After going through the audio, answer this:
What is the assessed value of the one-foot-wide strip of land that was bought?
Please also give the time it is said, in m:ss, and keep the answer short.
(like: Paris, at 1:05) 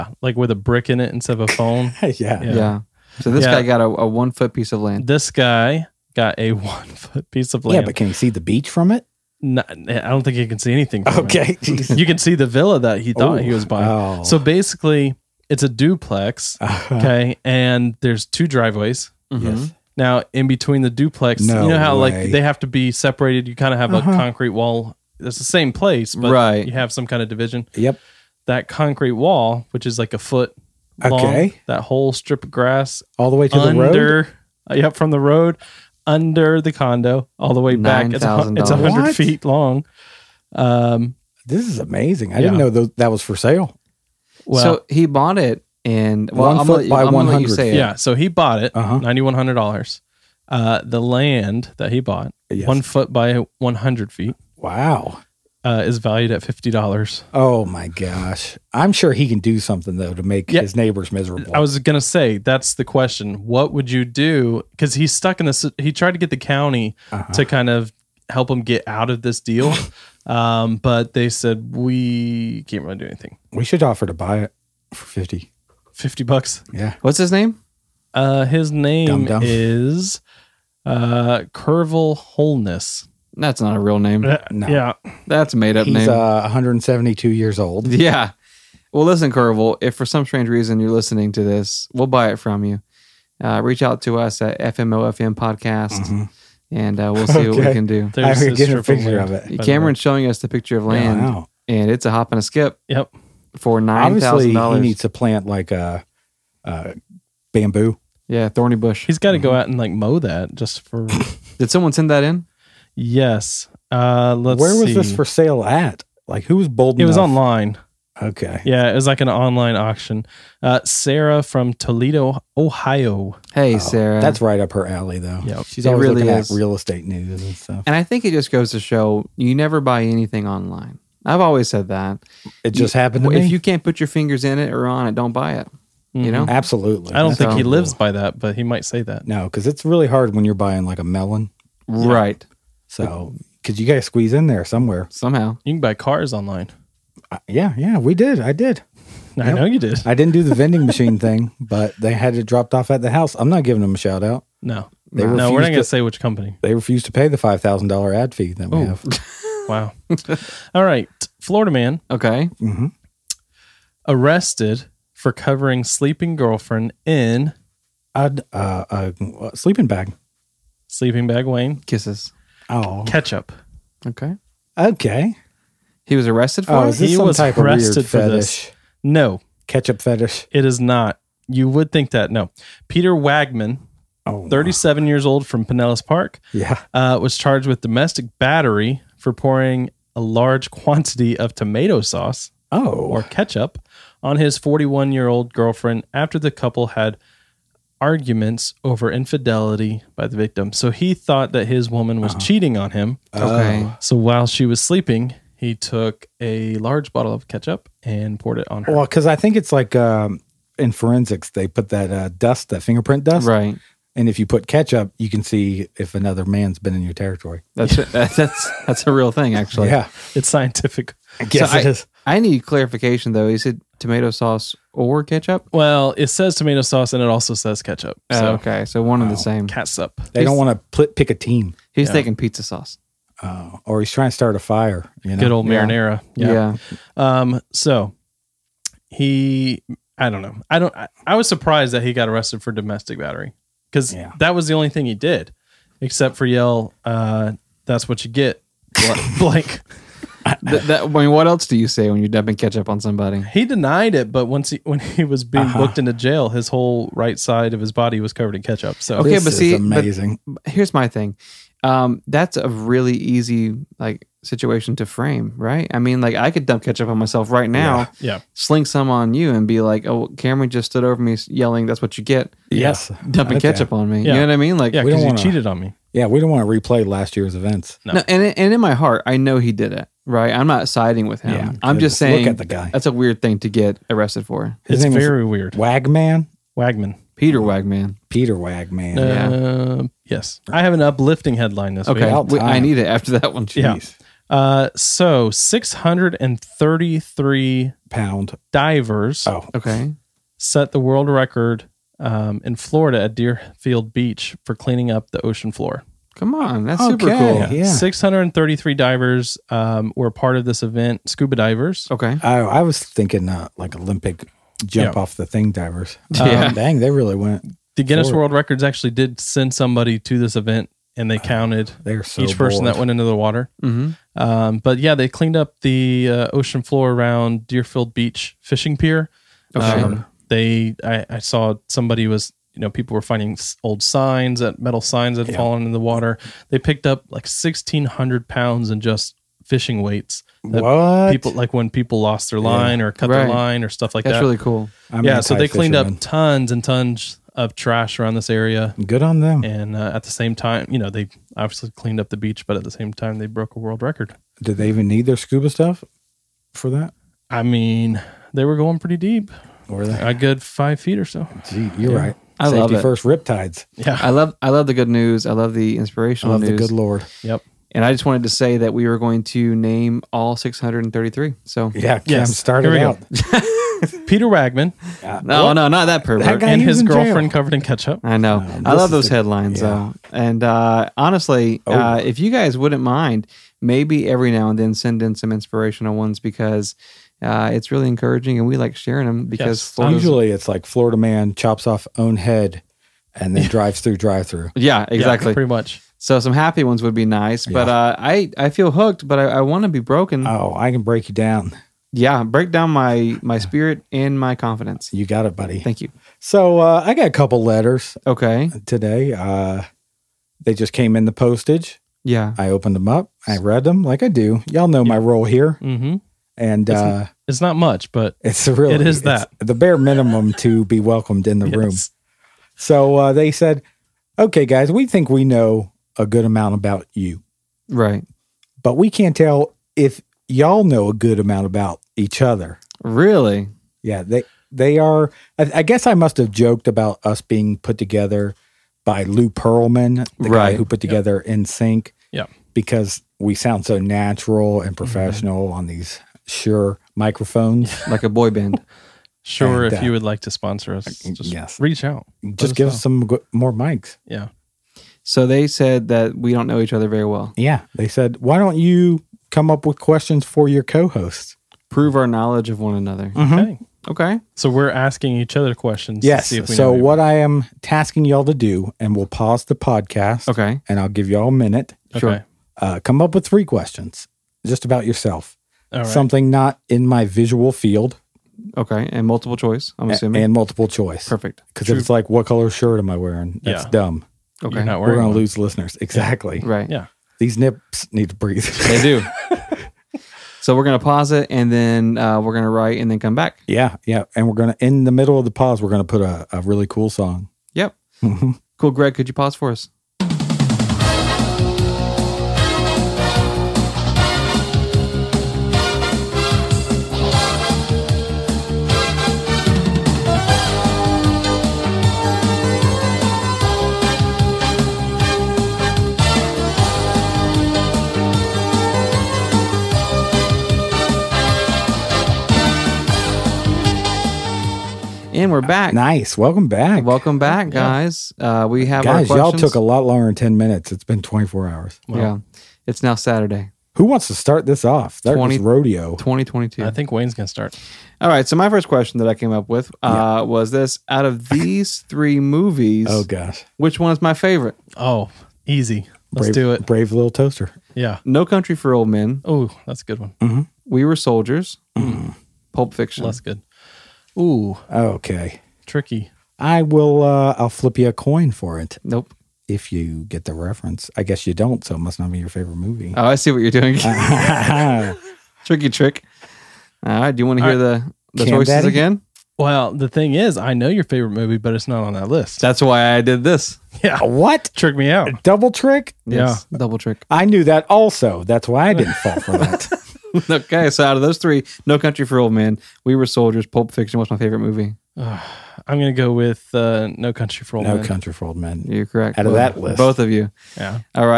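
$50, at 0:56.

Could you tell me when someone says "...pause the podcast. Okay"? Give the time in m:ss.
7:49.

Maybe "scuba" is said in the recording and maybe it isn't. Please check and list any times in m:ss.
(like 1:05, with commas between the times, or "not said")
5:11, 5:55.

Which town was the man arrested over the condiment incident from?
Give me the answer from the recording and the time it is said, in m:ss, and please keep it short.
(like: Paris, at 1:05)
Pinellas Park, at 3:05.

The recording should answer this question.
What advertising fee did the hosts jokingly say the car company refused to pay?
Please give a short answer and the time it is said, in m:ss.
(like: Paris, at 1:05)
$5,000, at 2:37.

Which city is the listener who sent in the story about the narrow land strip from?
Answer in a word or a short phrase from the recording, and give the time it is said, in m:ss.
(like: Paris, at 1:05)
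Toledo, Ohio, at 2:01.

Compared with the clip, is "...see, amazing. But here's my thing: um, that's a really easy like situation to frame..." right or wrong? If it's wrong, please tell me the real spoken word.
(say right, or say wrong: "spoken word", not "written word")
right.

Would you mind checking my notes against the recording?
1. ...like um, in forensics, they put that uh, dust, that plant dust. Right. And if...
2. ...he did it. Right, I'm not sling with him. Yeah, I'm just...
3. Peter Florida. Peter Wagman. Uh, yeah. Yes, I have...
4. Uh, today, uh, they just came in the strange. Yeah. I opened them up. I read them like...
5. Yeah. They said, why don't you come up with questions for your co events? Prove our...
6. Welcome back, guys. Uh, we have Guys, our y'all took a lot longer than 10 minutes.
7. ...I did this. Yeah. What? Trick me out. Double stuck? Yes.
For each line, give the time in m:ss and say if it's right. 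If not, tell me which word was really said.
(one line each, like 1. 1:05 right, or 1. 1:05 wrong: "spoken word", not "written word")
1. 3:29 wrong: "fingerprint", not "plant"
2. 4:39 wrong: "siding", not "sling"
3. 4:47 wrong: "Wagman", not "Florida"
4. 6:48 wrong: "postage", not "strange"
5. 7:37 wrong: "hosts", not "events"
6. 8:47 right
7. 9:33 wrong: "trick", not "stuck".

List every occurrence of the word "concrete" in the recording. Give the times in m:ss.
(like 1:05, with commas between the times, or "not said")
0:24, 0:28.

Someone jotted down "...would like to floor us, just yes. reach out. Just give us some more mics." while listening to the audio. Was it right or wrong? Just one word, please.
wrong.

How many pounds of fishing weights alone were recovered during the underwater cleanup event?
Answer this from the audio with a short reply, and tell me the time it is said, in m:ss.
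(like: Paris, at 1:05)
1,600, at 5:37.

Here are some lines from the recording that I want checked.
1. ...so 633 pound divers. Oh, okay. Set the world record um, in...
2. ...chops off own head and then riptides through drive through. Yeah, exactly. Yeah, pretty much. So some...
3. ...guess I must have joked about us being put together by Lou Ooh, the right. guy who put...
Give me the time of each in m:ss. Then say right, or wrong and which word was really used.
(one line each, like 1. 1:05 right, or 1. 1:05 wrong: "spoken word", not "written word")
1. 4:54 right
2. 6:31 wrong: "drives", not "riptides"
3. 7:15 wrong: "Pearlman", not "Ooh".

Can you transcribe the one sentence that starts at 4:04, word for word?
that was the only thing he did, except for yell.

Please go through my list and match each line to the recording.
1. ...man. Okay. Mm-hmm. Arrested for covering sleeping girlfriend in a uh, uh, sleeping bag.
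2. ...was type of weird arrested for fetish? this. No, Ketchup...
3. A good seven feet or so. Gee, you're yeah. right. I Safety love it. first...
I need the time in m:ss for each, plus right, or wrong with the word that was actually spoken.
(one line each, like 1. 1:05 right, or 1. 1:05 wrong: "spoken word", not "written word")
1. 2:41 right
2. 2:57 right
3. 6:00 wrong: "five", not "seven".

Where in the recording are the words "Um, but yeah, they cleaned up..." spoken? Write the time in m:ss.
5:24.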